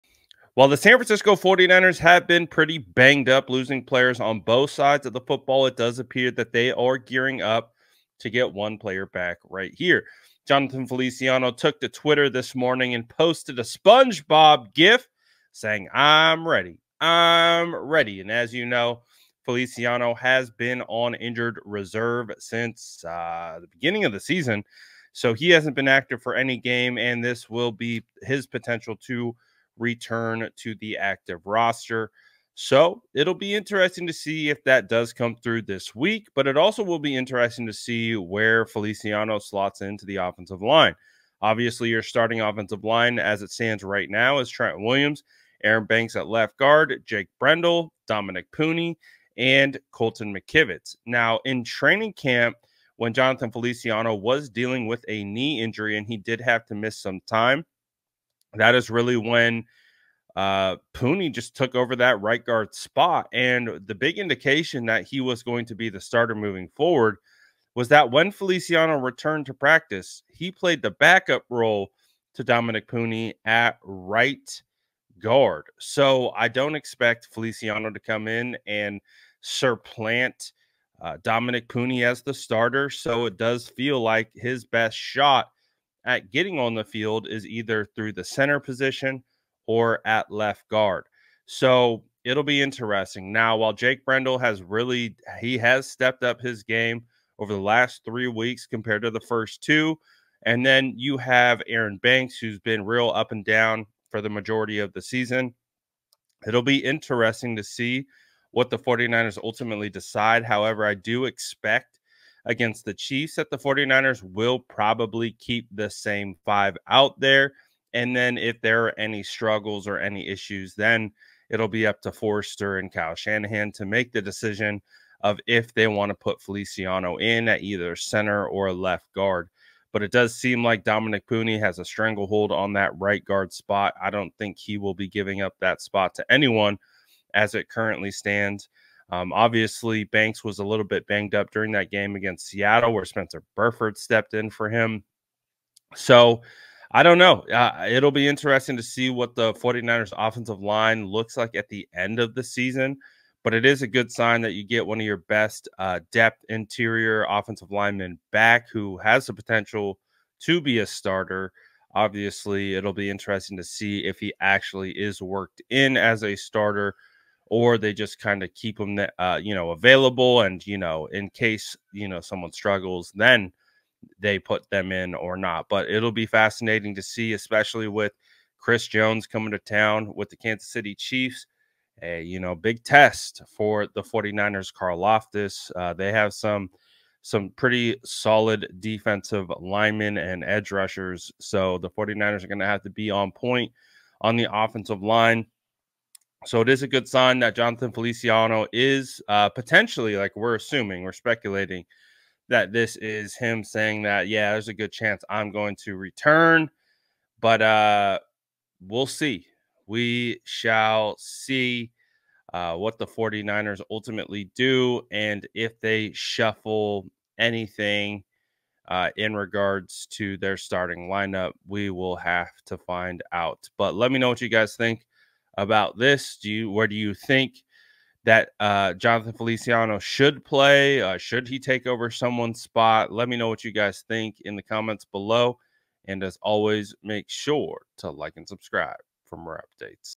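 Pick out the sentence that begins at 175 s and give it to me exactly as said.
But it'll be fascinating to see, especially with Chris Jones coming to town with the Kansas City Chiefs.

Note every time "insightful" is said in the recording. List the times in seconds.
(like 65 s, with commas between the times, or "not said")
not said.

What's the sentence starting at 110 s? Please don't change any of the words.
However, I do expect against the Chiefs that the 49ers will probably keep the same five out there.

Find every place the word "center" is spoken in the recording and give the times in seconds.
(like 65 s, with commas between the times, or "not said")
88 s, 127 s.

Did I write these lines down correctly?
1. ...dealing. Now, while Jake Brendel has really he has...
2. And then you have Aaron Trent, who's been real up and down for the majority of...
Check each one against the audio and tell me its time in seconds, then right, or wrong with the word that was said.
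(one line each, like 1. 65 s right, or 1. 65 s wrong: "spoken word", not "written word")
1. 92 s wrong: "interesting", not "dealing"
2. 100 s wrong: "Banks", not "Trent".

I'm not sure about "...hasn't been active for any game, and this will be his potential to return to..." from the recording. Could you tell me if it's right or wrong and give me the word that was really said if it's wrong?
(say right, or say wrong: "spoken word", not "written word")
right.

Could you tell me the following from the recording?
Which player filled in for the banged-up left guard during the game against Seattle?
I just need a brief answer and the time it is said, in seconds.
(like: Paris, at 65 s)
Spencer Burford, at 143 s.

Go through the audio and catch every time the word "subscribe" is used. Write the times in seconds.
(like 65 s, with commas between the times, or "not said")
238 s.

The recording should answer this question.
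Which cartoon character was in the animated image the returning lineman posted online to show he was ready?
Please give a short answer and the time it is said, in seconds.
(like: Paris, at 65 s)
SpongeBob, at 13 s.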